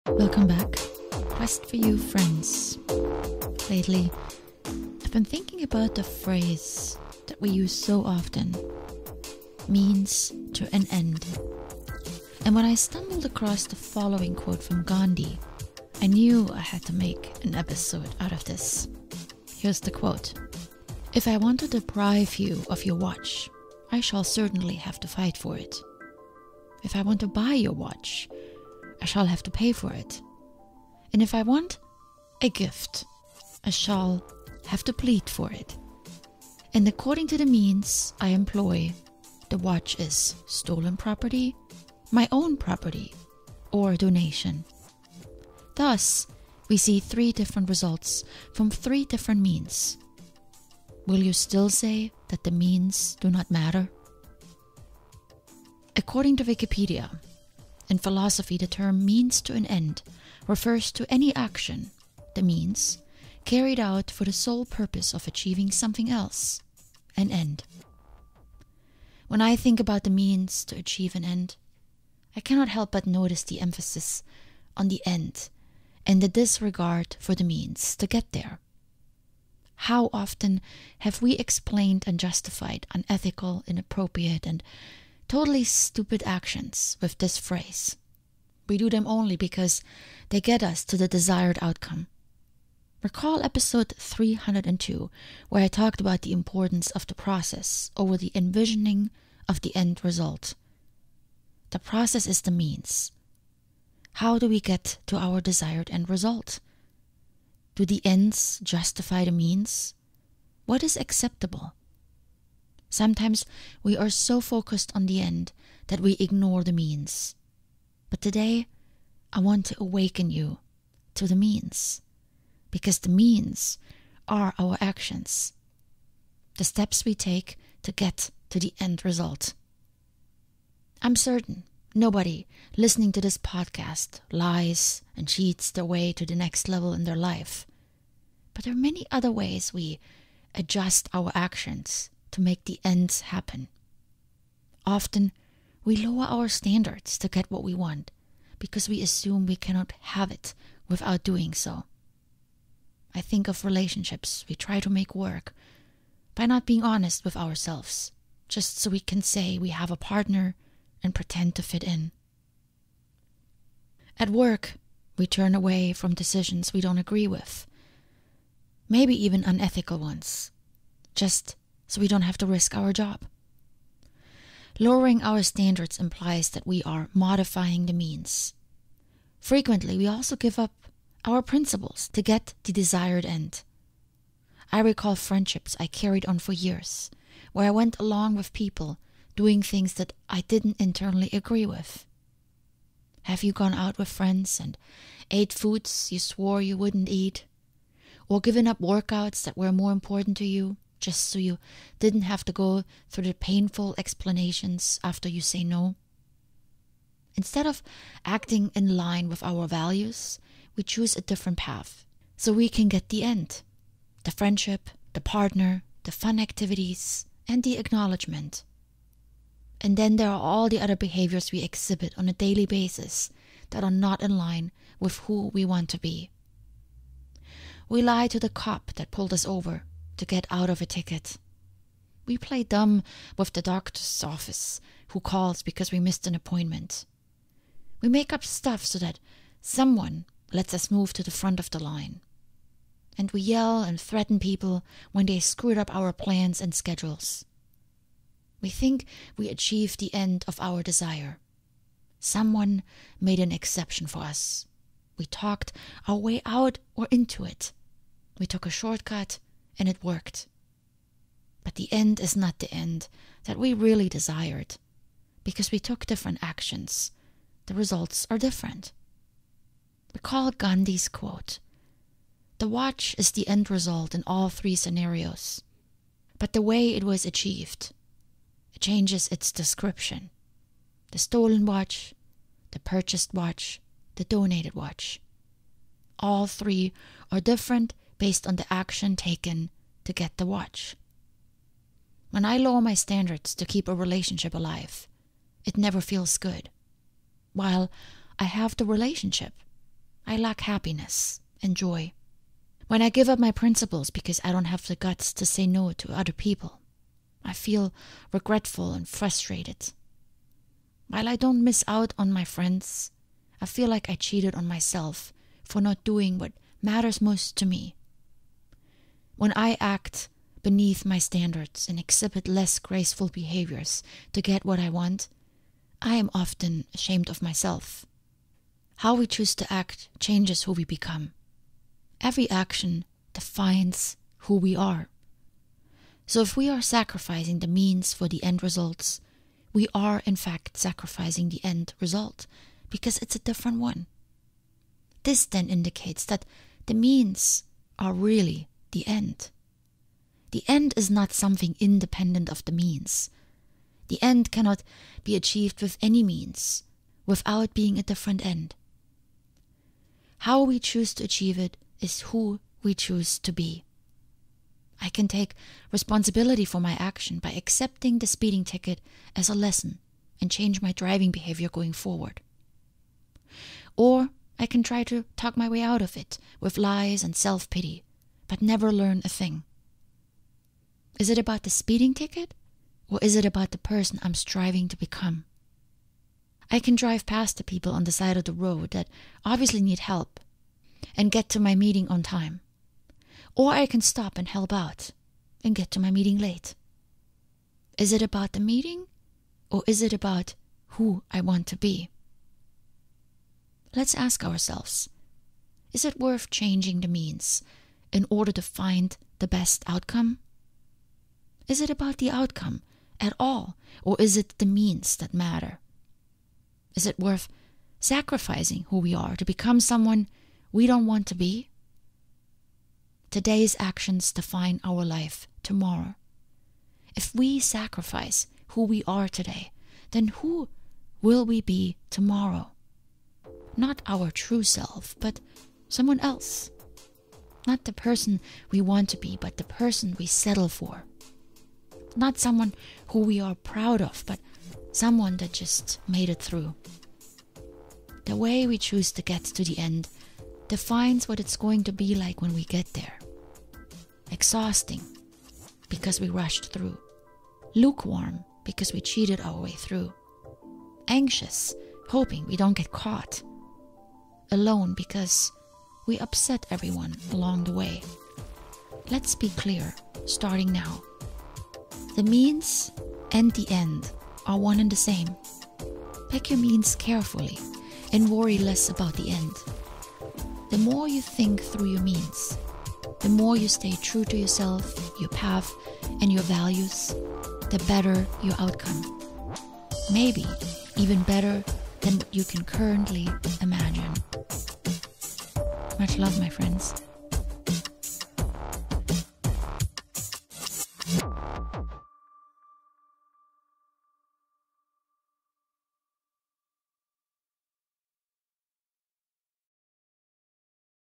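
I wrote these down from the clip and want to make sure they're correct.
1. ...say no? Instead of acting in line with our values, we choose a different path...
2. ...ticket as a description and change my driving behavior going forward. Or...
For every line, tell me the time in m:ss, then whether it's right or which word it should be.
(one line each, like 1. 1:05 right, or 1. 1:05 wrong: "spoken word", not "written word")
1. 3:25 right
2. 6:08 wrong: "lesson", not "description".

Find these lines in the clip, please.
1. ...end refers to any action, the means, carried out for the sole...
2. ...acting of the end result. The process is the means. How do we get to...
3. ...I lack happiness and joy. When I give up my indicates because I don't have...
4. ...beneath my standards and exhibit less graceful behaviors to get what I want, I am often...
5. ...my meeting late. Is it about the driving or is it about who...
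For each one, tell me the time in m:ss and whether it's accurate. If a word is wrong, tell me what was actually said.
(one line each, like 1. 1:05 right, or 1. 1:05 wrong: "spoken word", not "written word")
1. 0:59 right
2. 1:38 wrong: "envisioning", not "acting"
3. 5:00 wrong: "principles", not "indicates"
4. 5:20 right
5. 6:36 wrong: "meeting", not "driving".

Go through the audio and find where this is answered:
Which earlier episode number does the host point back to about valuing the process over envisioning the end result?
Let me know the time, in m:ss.
1:33.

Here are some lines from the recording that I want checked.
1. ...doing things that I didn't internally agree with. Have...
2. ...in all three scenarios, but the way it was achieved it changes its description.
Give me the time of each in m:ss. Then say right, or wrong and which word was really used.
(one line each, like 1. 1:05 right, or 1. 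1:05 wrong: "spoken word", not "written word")
1. 3:09 right
2. 4:34 right.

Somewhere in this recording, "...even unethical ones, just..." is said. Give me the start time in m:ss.
2:49.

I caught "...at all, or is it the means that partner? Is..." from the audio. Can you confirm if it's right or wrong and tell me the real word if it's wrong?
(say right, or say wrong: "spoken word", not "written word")
wrong: "matter", not "partner".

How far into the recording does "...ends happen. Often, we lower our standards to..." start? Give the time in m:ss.
2:22.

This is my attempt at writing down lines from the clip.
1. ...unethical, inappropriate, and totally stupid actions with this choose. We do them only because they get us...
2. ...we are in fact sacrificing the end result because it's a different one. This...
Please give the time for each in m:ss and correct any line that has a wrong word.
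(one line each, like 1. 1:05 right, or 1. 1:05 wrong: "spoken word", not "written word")
1. 1:22 wrong: "phrase", not "choose"
2. 5:39 right.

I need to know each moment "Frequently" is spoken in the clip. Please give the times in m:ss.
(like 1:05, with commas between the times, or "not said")
2:59.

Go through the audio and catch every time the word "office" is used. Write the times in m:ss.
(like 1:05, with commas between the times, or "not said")
3:54.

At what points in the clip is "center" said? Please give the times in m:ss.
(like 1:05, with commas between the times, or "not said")
not said.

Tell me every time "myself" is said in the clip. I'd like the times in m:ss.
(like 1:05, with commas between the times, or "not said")
5:14, 5:27.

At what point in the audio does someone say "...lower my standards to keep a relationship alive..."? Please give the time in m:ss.
4:52.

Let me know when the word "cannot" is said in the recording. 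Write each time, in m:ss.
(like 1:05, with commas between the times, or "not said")
1:12, 2:29, 5:54.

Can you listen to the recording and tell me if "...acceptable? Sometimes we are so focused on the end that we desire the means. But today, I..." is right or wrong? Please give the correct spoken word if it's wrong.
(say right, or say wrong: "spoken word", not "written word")
wrong: "ignore", not "desire".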